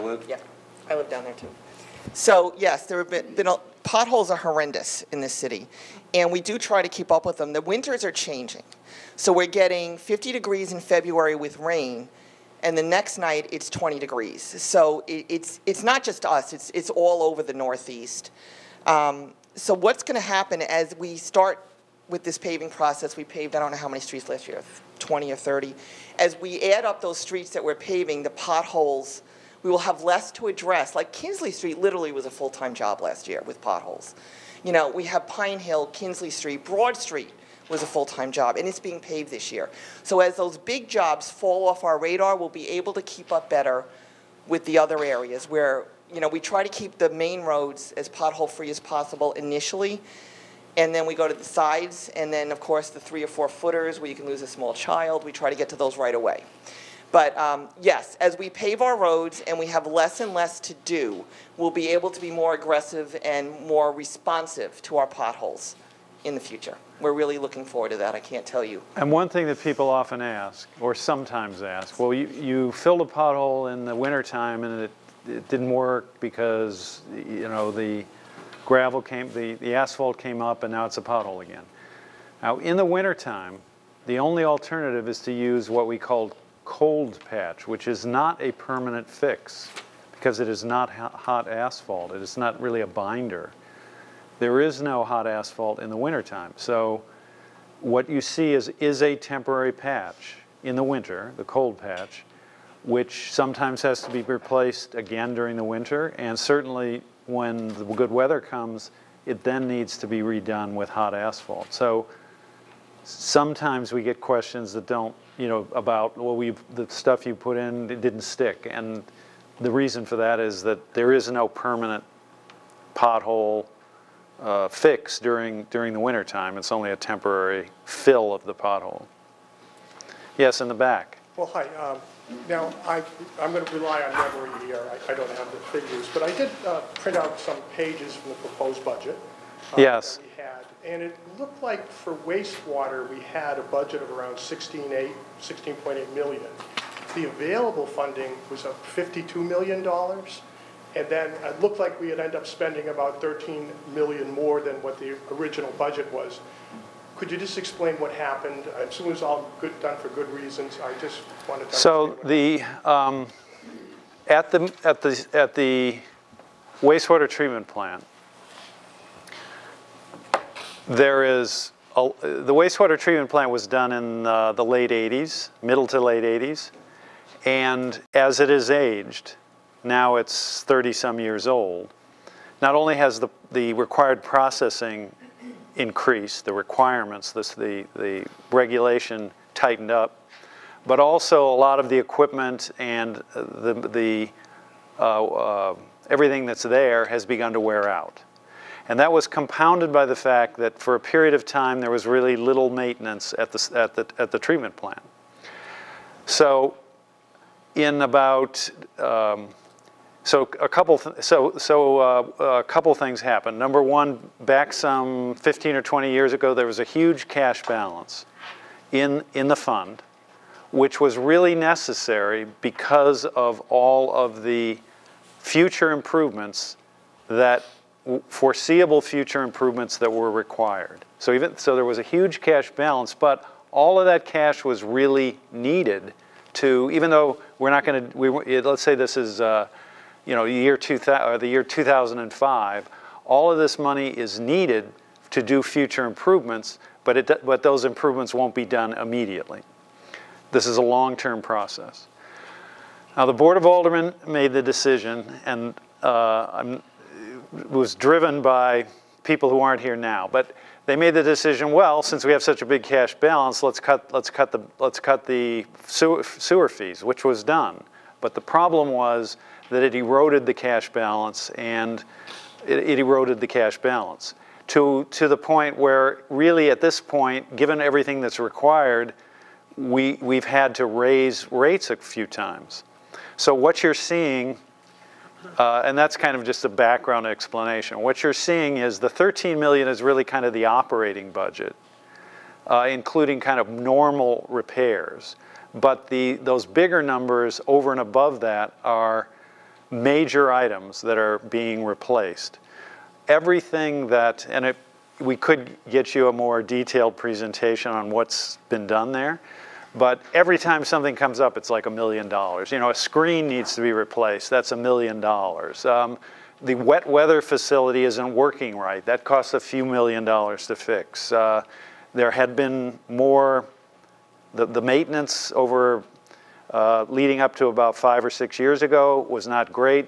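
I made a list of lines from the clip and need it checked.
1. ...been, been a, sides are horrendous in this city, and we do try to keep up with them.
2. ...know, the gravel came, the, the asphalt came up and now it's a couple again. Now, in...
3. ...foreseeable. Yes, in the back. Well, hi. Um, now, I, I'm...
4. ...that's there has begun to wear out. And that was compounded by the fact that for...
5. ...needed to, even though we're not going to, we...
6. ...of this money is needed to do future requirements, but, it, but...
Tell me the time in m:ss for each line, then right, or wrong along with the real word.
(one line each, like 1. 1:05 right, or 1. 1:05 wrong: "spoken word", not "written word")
1. 0:03 wrong: "potholes", not "sides"
2. 1:17 wrong: "pothole", not "couple"
3. 2:08 wrong: "pothole", not "foreseeable"
4. 3:16 right
5. 3:55 right
6. 4:03 wrong: "improvements", not "requirements".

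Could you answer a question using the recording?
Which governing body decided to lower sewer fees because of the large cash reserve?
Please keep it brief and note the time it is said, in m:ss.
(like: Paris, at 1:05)
Board of Aldermen, at 4:13.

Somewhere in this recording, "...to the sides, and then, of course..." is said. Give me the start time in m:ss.
0:51.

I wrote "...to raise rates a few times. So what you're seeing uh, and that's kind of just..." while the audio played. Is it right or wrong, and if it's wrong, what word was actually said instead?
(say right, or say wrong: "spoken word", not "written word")
right.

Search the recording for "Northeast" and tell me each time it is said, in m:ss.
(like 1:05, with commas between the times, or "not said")
0:17.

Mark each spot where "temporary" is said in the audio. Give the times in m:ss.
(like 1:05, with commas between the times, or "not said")
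1:39, 2:06.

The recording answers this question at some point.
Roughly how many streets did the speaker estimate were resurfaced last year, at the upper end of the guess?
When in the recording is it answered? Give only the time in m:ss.
0:24.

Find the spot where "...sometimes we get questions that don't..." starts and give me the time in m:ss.
1:53.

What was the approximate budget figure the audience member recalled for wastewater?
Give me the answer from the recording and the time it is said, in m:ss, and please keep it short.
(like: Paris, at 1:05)
16.8 million, at 2:25.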